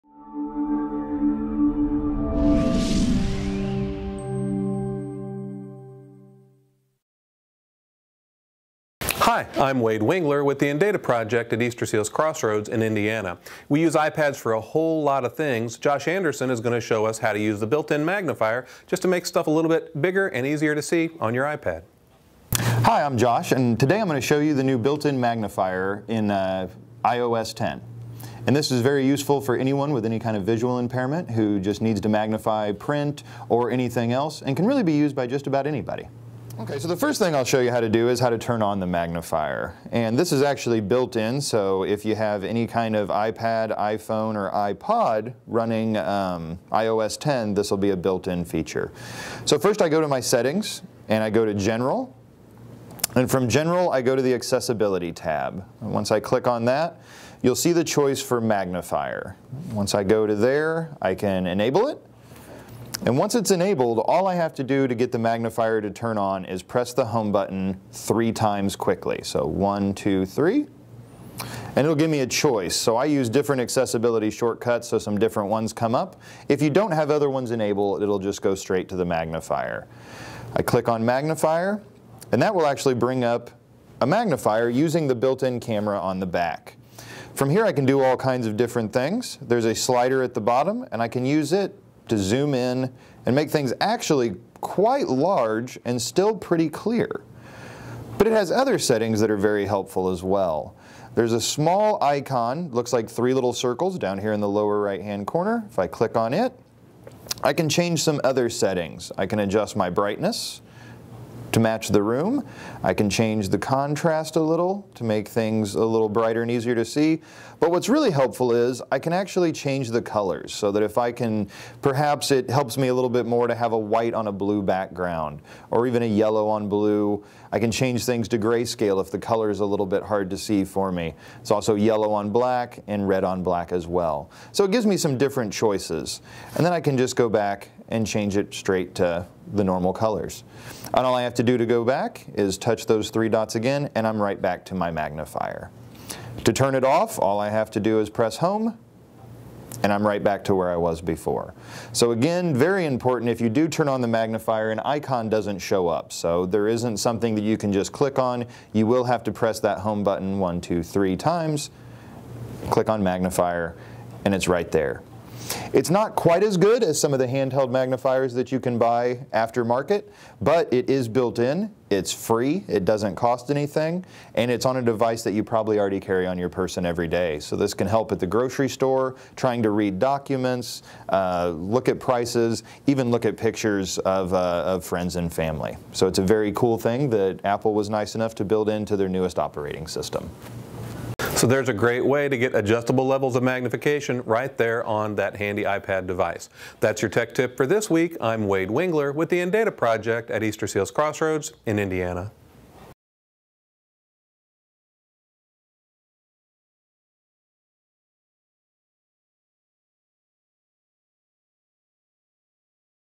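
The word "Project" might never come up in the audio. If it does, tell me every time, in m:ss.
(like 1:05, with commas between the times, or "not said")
0:10, 3:19.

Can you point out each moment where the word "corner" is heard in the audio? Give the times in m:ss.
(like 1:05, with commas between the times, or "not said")
1:45.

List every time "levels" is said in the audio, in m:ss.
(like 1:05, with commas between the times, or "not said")
3:13.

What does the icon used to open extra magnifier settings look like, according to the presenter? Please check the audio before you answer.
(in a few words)
three little circles.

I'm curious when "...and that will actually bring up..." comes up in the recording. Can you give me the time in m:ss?
1:22.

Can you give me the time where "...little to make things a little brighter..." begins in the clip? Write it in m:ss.
1:54.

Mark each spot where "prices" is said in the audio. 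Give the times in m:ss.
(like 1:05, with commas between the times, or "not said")
3:01.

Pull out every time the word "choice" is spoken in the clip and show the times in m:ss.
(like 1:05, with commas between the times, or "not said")
0:57, 1:12, 2:15.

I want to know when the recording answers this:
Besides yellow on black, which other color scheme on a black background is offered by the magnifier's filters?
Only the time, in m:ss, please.
2:13.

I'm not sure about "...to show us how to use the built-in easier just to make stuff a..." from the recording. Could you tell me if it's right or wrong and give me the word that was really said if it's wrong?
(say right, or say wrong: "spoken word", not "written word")
wrong: "magnifier", not "easier".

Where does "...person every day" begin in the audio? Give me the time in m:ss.
2:56.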